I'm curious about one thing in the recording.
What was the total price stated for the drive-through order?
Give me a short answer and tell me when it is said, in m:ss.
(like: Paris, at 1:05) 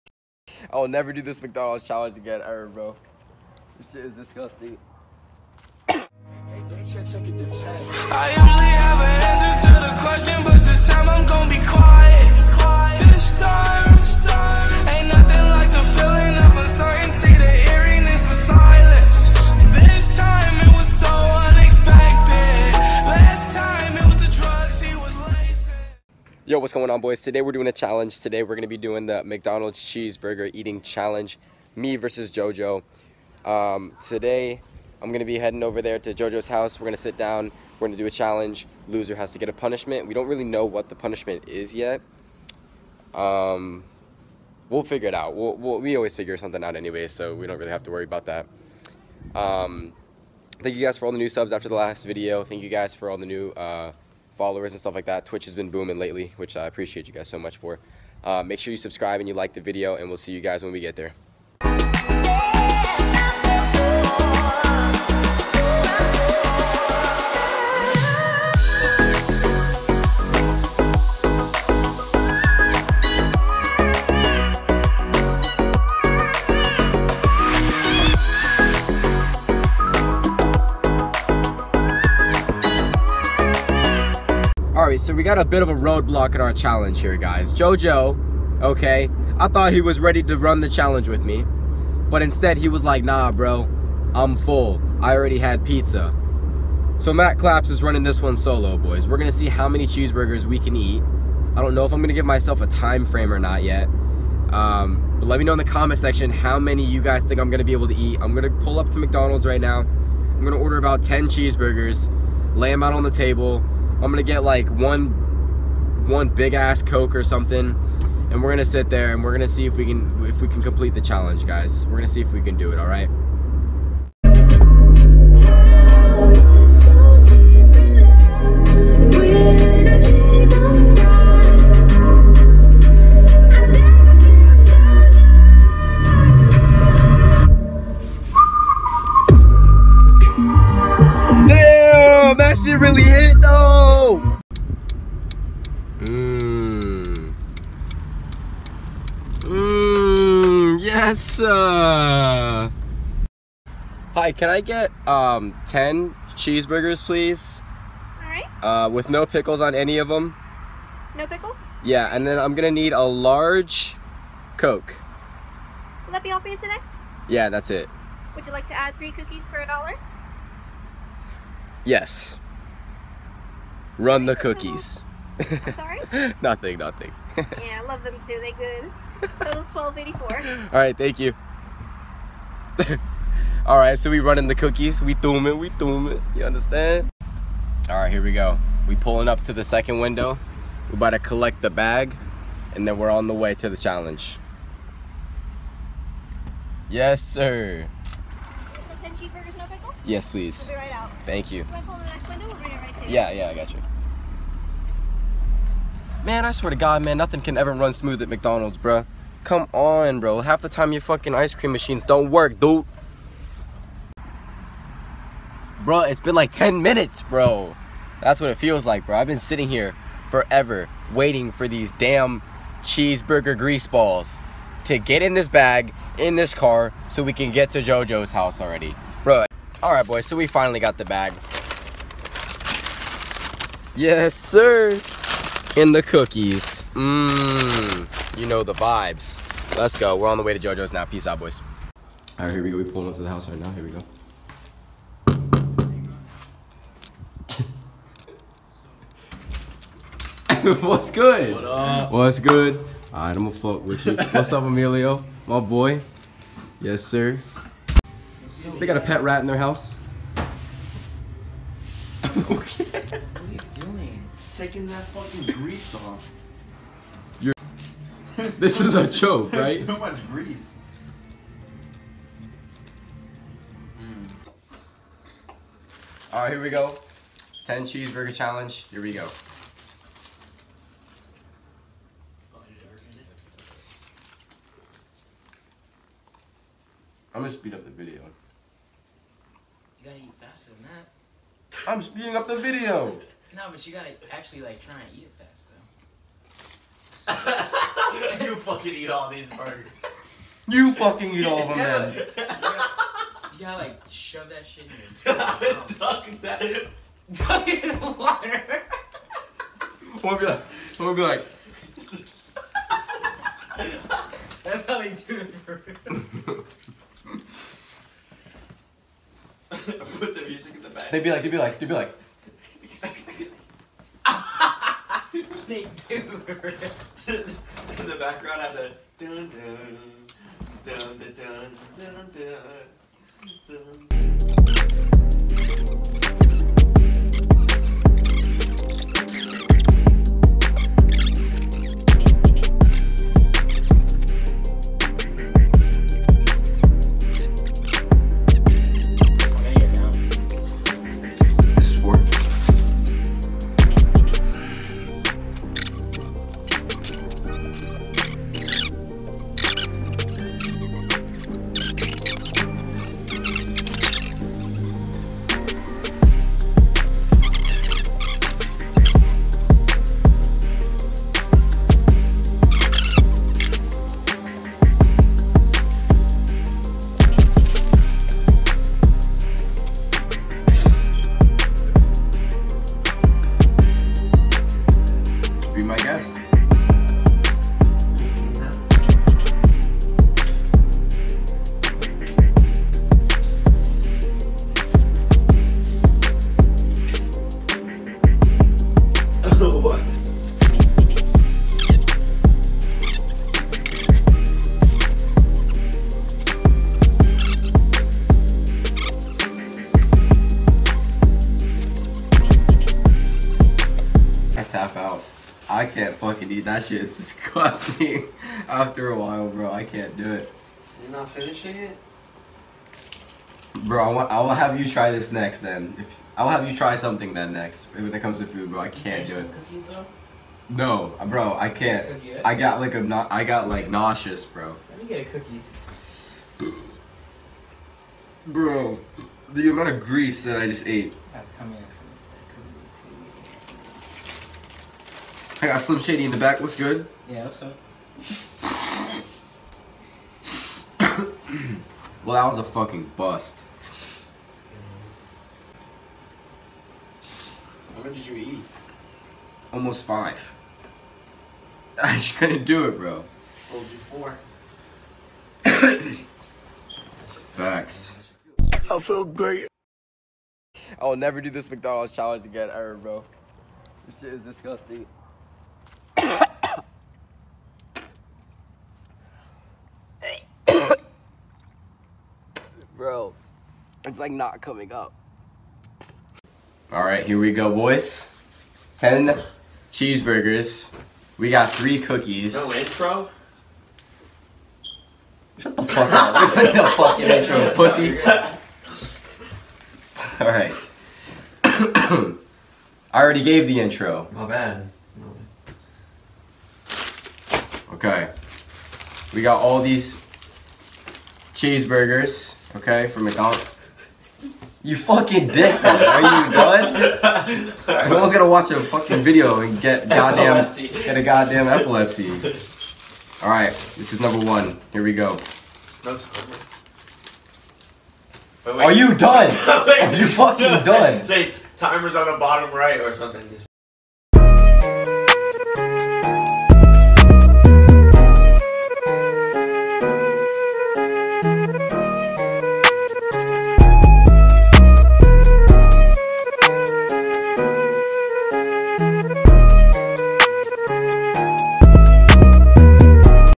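12.84, at 2:59.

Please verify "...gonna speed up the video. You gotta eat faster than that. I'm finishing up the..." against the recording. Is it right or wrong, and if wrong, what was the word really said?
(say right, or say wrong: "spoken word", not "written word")
wrong: "speeding", not "finishing".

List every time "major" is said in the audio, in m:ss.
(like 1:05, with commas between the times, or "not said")
not said.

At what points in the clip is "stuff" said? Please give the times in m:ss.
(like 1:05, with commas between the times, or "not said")
0:54.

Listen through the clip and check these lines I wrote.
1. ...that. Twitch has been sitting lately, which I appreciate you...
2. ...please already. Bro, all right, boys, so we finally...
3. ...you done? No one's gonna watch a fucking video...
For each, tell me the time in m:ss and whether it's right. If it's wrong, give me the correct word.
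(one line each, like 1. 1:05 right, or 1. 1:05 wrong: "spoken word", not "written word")
1. 0:55 wrong: "booming", not "sitting"
2. 3:48 wrong: "house", not "please"
3. 8:36 right.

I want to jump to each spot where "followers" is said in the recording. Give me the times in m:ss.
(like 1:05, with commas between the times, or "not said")
0:54.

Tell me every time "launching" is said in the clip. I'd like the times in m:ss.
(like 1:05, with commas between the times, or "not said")
not said.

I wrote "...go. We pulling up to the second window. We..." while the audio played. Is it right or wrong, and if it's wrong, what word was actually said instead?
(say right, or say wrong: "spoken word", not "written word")
right.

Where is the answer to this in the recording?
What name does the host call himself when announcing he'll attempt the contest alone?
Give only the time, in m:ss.
1:37.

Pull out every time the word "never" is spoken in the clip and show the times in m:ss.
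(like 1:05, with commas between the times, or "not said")
0:00, 7:51.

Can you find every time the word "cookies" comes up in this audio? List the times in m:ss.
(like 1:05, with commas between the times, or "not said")
2:49, 2:54, 3:04, 3:56, 7:09, 7:15, 8:11.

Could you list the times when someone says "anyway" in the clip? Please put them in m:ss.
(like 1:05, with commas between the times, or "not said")
0:46.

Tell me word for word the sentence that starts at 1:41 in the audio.
I don't know if I'm gonna give myself a time frame or not yet.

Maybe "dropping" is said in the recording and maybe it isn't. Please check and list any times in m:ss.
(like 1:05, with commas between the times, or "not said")
not said.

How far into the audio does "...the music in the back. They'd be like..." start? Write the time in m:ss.
5:20.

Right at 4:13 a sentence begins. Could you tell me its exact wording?
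All right, I'm gonna fuck with you.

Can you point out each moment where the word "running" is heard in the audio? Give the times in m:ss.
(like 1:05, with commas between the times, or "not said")
1:37, 3:04.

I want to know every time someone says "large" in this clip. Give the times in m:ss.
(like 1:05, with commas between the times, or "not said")
2:43.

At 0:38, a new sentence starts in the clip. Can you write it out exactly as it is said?
Loser has to get a punishment.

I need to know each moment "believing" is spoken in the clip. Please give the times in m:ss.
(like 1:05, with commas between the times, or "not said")
not said.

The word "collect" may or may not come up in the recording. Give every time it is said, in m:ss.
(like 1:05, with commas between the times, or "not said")
3:11.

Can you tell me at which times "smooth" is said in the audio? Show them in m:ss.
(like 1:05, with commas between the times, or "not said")
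3:27.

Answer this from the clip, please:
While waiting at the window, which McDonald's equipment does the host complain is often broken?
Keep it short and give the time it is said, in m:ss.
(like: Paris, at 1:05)
Ice cream machines, at 3:31.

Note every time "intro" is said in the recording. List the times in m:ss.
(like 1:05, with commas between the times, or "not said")
8:12, 8:17, 8:23.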